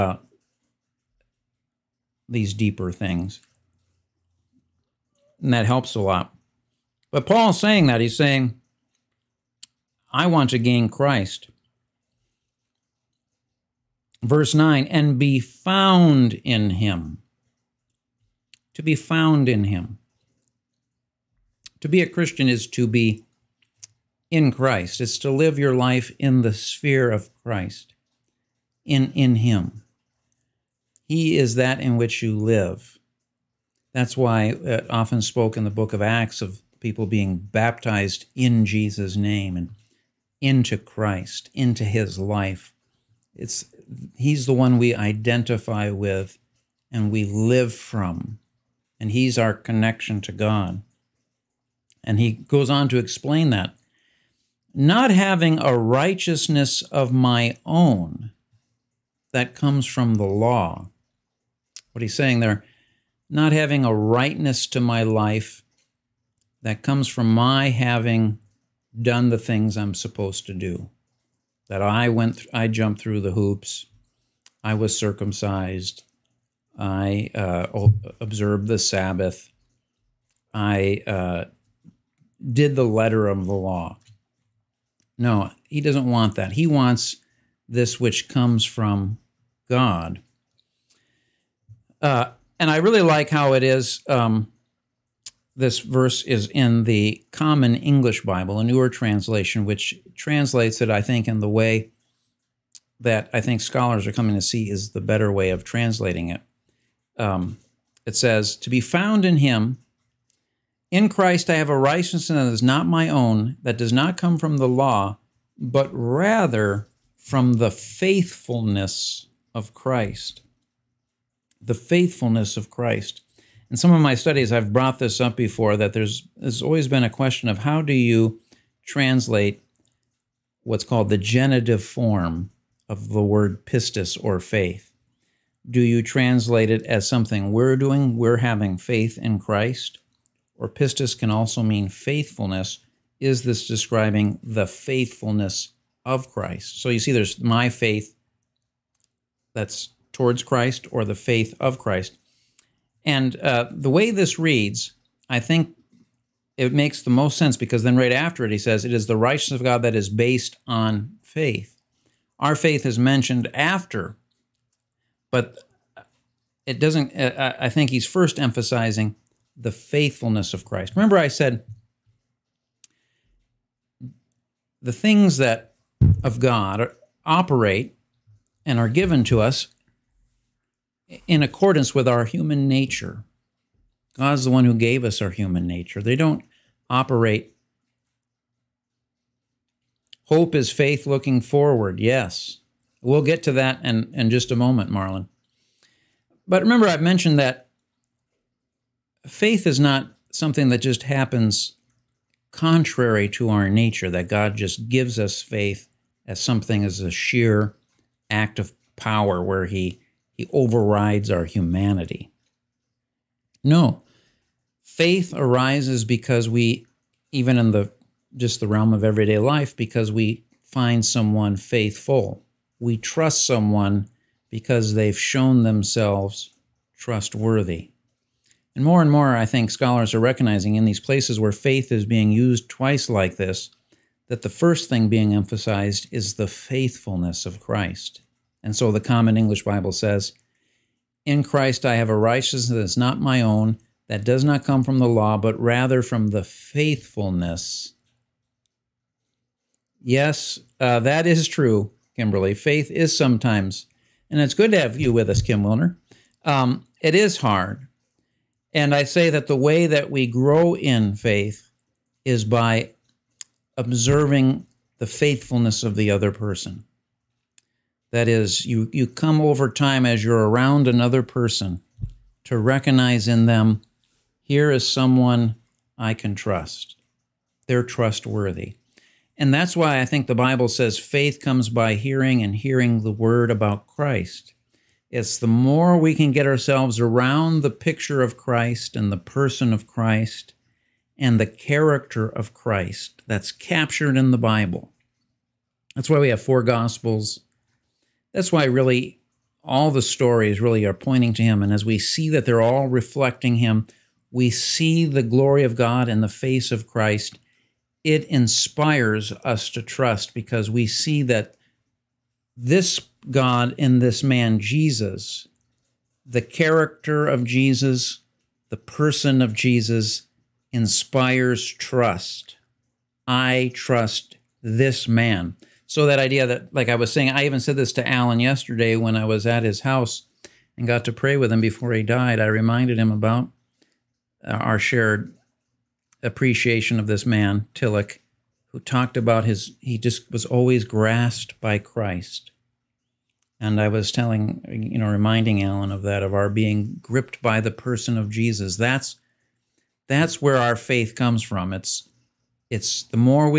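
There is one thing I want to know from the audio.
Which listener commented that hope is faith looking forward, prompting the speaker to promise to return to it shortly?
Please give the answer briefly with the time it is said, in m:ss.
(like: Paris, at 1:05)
Marlon, at 3:14.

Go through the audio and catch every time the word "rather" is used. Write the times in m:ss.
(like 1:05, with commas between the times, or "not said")
1:55, 4:05.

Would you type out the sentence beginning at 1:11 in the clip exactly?
That I went, I jumped through the hoops.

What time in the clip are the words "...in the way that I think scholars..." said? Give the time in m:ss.
1:41.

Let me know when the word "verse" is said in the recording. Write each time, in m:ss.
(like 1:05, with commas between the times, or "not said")
0:14, 1:35.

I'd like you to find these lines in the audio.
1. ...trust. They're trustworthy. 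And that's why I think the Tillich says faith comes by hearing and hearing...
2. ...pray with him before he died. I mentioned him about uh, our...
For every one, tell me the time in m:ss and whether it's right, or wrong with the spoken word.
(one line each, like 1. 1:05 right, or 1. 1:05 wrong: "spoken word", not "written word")
1. 4:36 wrong: "Bible", not "Tillich"
2. 5:31 wrong: "reminded", not "mentioned".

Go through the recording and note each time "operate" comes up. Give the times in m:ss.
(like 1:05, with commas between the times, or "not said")
2:57, 3:06.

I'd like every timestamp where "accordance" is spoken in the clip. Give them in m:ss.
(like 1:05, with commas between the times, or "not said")
3:01.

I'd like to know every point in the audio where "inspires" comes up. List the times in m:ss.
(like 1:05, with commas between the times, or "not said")
5:08, 5:20.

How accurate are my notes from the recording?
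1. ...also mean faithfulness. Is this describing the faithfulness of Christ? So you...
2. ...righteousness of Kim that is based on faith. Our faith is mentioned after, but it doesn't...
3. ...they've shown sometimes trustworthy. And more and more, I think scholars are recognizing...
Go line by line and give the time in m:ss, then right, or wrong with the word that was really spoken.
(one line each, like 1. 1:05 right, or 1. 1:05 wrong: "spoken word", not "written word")
1. 2:21 right
2. 2:39 wrong: "God", not "Kim"
3. 3:44 wrong: "themselves", not "sometimes".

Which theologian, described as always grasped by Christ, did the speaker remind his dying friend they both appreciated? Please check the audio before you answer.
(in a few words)
Tillich.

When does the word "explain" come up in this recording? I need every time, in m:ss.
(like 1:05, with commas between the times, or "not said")
0:52.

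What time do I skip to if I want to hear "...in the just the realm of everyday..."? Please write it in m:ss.
3:37.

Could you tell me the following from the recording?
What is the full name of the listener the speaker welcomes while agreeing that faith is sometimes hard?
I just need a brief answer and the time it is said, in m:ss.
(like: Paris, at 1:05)
Kim Wilner, at 4:15.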